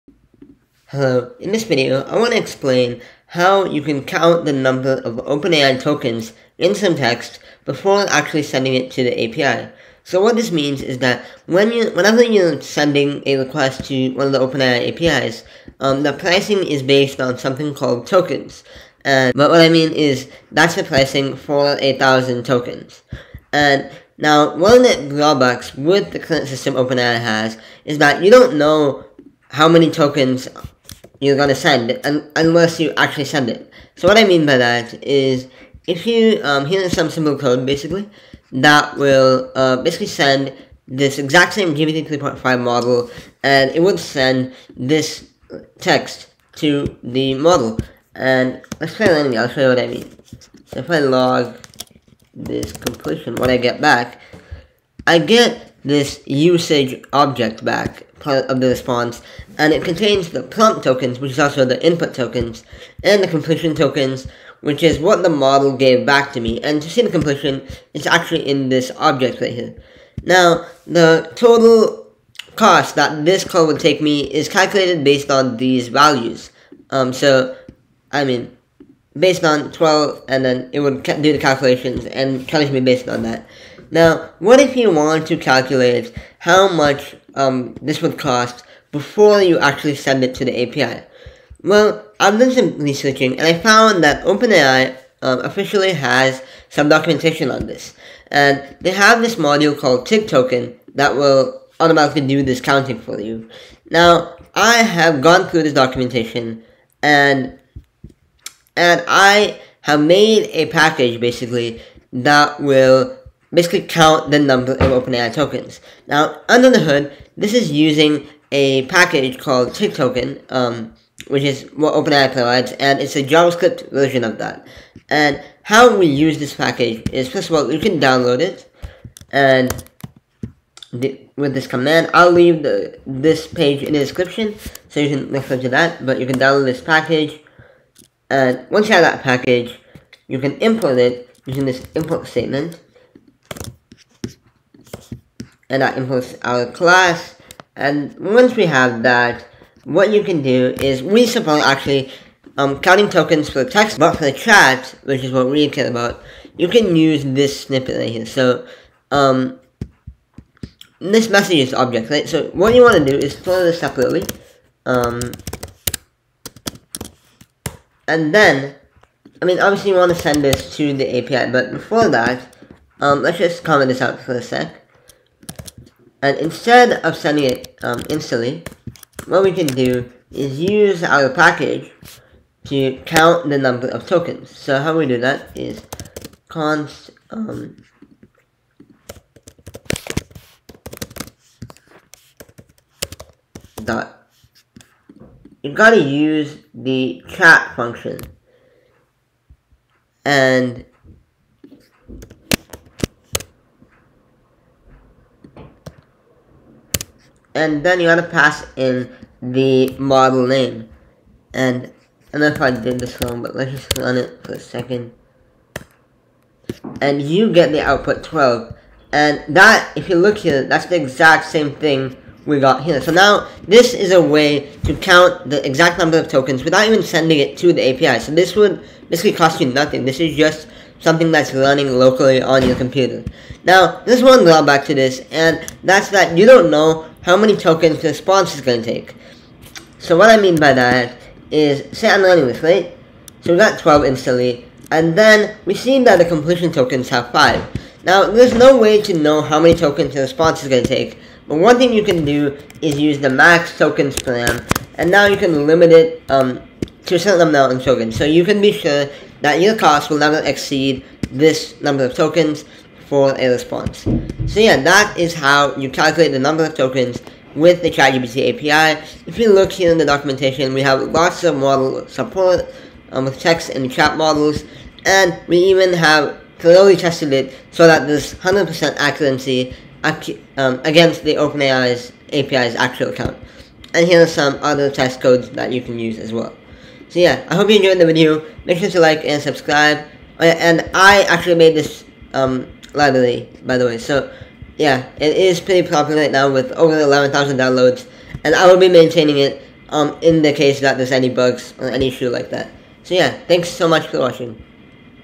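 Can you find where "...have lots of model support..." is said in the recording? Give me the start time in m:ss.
4:30.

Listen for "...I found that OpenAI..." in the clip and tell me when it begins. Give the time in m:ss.
1:33.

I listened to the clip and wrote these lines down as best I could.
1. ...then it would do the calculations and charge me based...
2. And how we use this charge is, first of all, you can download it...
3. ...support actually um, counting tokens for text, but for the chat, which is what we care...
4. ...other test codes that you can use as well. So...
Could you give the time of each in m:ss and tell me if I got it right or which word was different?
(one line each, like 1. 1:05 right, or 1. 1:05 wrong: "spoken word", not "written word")
1. 1:20 right
2. 2:05 wrong: "package", not "charge"
3. 2:31 right
4. 4:44 right.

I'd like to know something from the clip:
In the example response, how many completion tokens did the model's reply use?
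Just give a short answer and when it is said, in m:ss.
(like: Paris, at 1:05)
5, at 4:06.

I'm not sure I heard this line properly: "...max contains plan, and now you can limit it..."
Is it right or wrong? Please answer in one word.
wrong.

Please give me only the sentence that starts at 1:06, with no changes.
And to see the completion, it's actually in this object right here.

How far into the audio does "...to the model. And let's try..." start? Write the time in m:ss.
0:46.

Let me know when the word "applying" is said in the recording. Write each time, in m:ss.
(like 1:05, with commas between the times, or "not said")
not said.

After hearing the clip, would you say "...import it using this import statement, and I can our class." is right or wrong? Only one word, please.
right.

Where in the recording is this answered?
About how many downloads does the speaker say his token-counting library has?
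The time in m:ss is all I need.
4:56.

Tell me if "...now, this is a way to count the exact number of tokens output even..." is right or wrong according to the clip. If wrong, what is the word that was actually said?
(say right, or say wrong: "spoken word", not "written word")
wrong: "without", not "output".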